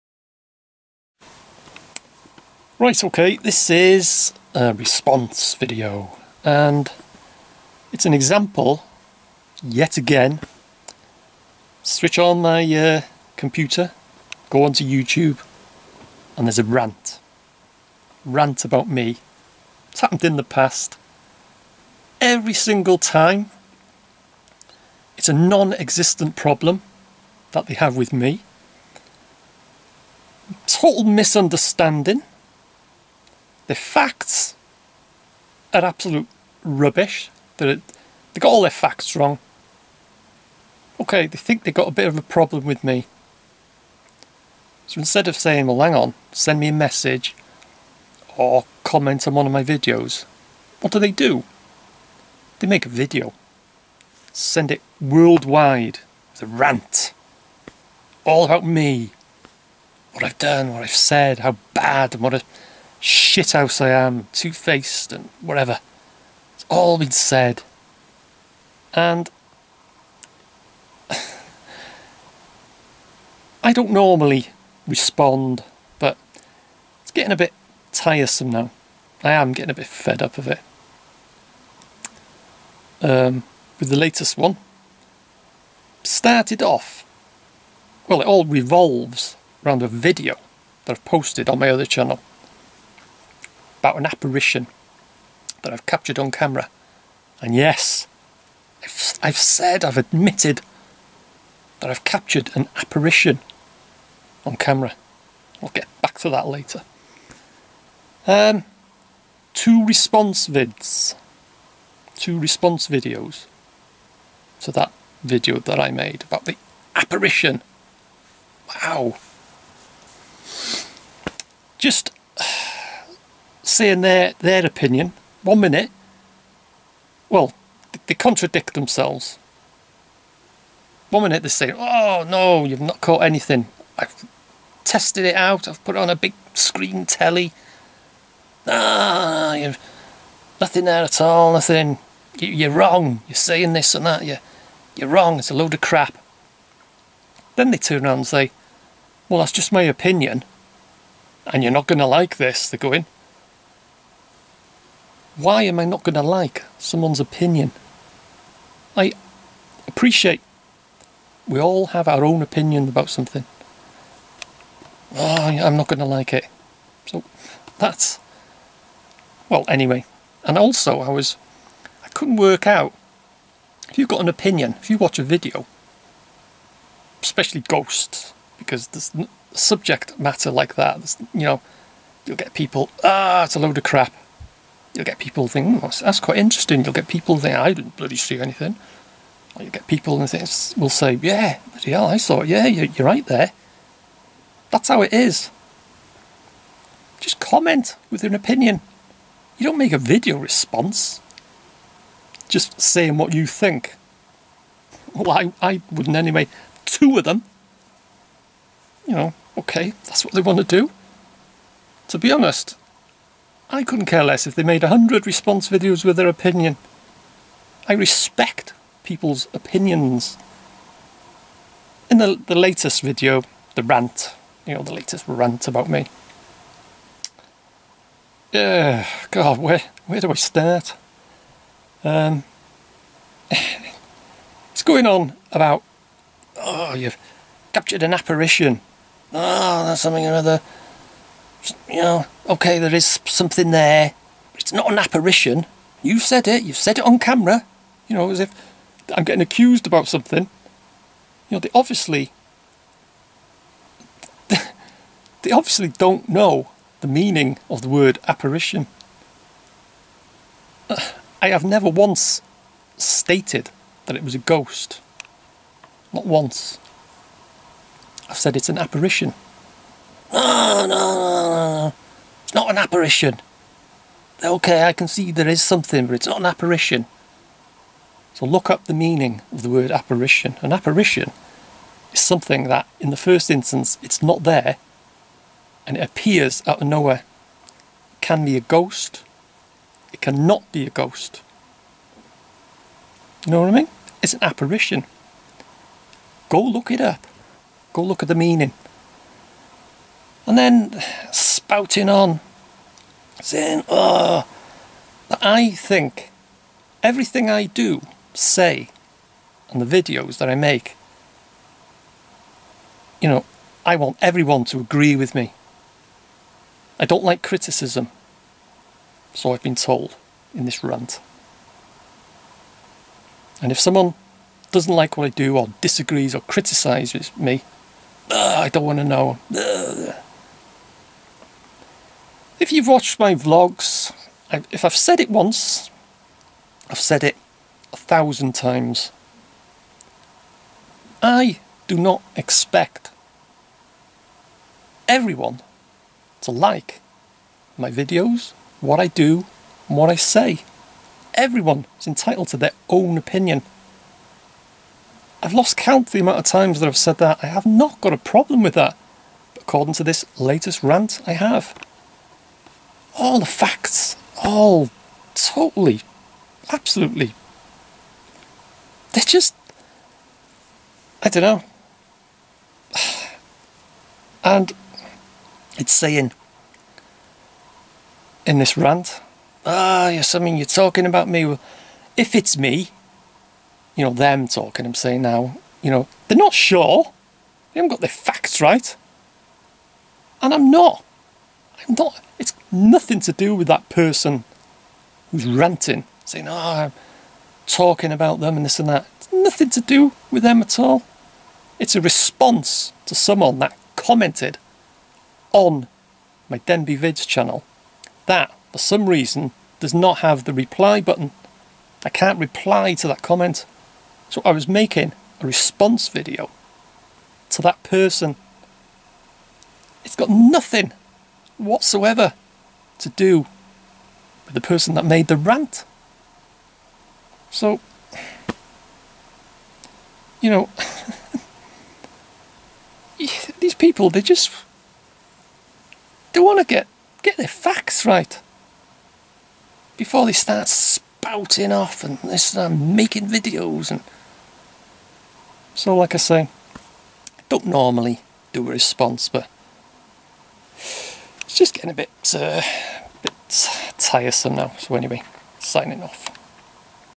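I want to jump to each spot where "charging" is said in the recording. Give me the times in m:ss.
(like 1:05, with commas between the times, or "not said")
not said.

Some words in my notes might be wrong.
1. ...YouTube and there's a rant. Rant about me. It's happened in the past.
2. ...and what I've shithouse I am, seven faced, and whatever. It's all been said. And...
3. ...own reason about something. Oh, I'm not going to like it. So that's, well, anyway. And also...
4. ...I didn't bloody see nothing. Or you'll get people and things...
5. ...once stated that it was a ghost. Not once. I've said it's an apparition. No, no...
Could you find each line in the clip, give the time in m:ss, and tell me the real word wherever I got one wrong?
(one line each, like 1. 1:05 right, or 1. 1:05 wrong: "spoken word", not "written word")
1. 0:14 right
2. 1:02 wrong: "two", not "seven"
3. 2:42 wrong: "opinion", not "reason"
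4. 3:07 wrong: "anything", not "nothing"
5. 4:21 right.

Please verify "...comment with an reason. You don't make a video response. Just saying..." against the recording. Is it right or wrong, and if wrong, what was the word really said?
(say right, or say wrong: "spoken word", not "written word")
wrong: "opinion", not "reason".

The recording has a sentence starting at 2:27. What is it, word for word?
Then they turn around and say, well, that's just my opinion, and you're not going to like this.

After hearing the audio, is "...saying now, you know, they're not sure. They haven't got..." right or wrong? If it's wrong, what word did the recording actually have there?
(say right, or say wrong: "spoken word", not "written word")
right.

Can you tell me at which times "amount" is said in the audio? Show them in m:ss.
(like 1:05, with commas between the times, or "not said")
5:56.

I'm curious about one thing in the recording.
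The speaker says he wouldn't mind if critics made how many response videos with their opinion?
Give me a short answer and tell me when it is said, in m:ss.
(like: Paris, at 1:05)
100, at 3:34.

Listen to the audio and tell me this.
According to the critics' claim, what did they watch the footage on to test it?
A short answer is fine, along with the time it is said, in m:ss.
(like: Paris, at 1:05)
big screen telly, at 2:16.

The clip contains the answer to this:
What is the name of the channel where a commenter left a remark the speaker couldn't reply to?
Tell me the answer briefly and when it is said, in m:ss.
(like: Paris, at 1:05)
Denbigh Vids, at 6:46.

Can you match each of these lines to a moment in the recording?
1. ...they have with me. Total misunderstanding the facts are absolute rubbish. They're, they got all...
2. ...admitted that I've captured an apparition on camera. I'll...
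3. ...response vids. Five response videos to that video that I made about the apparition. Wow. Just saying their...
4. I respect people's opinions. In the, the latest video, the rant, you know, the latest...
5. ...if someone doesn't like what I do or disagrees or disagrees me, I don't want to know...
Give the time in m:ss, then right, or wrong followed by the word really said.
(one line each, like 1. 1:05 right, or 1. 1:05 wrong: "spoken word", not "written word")
1. 0:27 right
2. 1:39 right
3. 1:49 wrong: "Two", not "Five"
4. 3:37 right
5. 5:23 wrong: "criticises", not "disagrees".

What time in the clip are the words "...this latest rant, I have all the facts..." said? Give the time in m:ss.
6:00.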